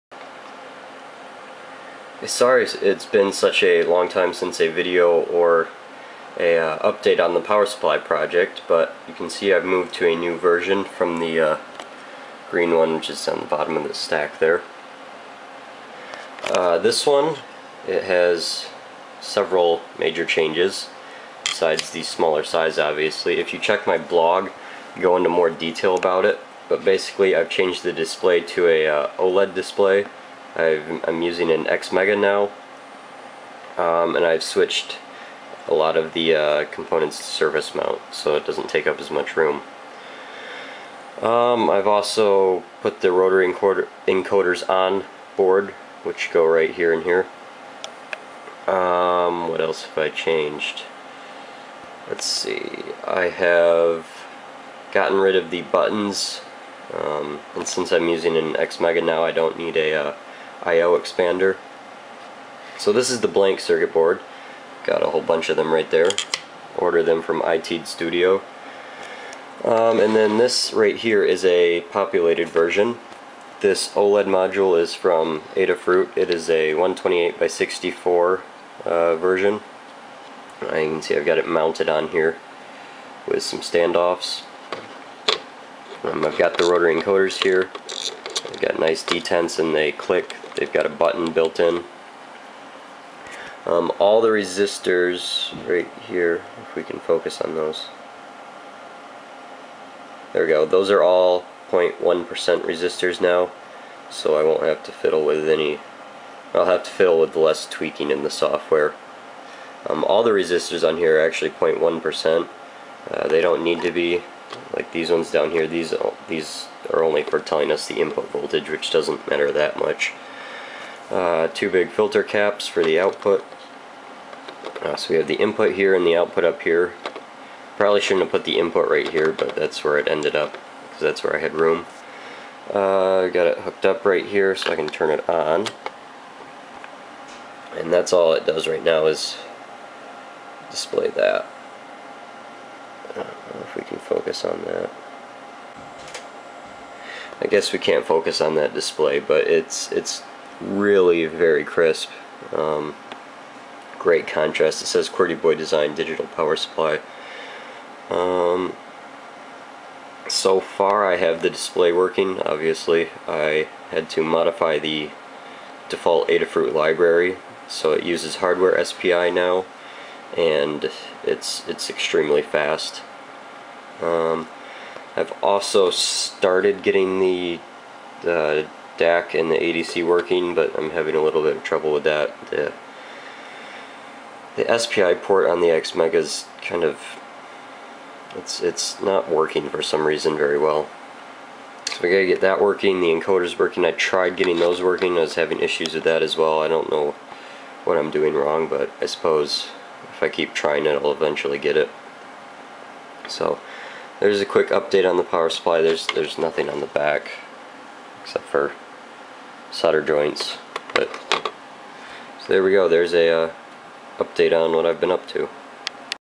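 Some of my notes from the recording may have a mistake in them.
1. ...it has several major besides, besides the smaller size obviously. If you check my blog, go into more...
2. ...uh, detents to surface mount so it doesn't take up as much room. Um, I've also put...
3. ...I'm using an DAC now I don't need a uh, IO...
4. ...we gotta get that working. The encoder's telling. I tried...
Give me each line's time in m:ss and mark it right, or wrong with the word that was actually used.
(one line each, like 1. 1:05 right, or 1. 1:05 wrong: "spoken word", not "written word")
1. 0:17 wrong: "changes", not "besides"
2. 0:36 wrong: "components", not "detents"
3. 0:57 wrong: "XMEGA", not "DAC"
4. 3:12 wrong: "working", not "telling".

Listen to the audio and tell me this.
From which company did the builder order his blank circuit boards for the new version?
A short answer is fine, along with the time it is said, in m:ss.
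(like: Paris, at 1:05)
ITEAD Studio, at 1:07.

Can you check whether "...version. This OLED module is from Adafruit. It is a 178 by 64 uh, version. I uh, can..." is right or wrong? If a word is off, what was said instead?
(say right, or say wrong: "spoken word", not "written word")
wrong: "128", not "178".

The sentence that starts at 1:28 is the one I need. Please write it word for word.
I've got nice detents and they click They've got a button built in.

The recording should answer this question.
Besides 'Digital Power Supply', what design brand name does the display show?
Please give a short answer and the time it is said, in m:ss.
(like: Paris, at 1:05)
QWERTY Boy Design, at 2:35.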